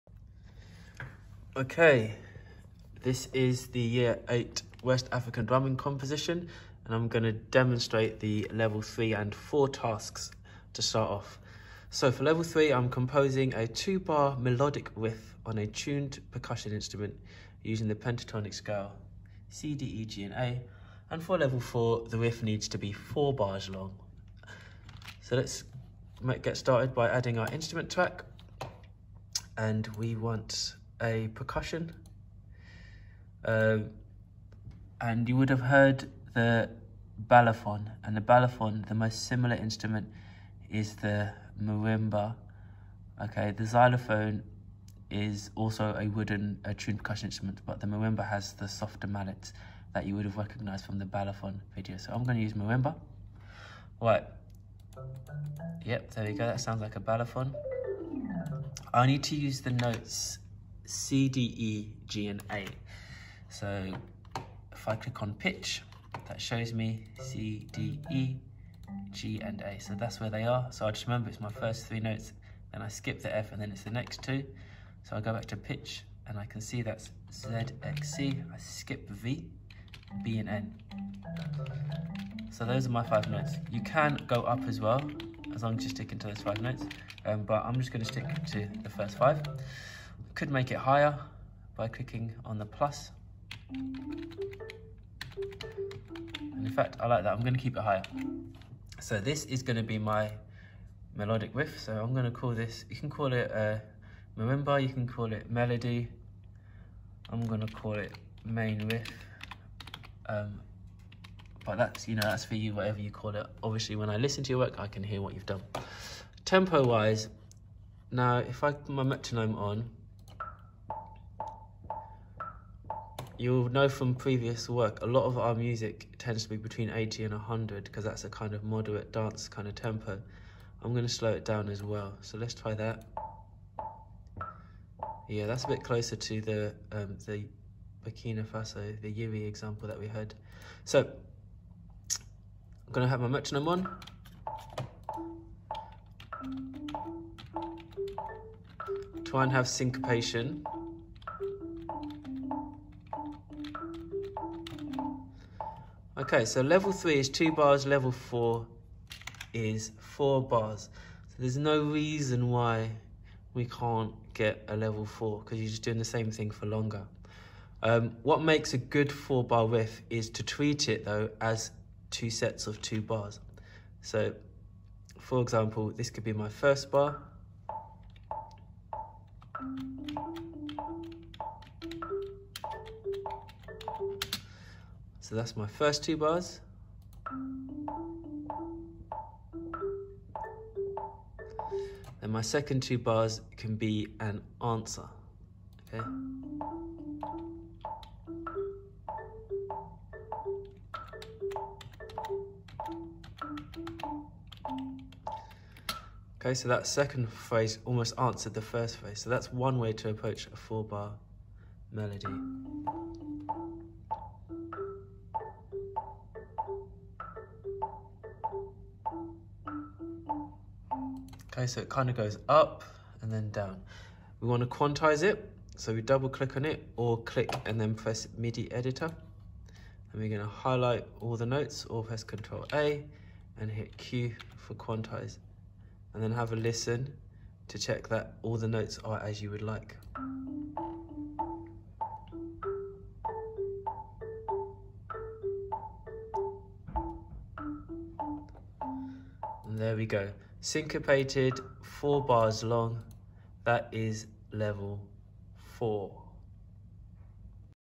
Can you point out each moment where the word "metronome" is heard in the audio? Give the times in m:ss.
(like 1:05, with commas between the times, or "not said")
1:59, 2:23.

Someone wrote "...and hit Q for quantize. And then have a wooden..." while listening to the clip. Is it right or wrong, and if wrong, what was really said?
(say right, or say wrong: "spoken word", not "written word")
wrong: "listen", not "wooden".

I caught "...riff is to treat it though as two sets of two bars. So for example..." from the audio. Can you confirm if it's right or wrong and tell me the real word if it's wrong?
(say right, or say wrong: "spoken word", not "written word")
right.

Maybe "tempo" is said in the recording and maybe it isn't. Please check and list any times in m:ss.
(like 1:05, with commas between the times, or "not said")
1:56, 2:09.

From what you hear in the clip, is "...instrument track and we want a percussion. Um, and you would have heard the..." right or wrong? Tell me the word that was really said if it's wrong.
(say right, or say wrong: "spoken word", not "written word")
right.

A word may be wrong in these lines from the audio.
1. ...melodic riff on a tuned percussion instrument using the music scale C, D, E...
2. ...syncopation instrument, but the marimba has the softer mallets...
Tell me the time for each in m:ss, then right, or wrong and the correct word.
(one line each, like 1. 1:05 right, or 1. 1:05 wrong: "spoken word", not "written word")
1. 0:14 wrong: "pentatonic", not "music"
2. 0:46 wrong: "percussion", not "syncopation".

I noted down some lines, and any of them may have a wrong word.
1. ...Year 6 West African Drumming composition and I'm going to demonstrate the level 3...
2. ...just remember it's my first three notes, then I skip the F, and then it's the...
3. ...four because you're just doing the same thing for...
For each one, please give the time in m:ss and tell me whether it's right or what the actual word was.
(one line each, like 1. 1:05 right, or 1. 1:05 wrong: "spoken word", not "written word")
1. 0:03 wrong: "8", not "6"
2. 1:10 right
3. 2:45 right.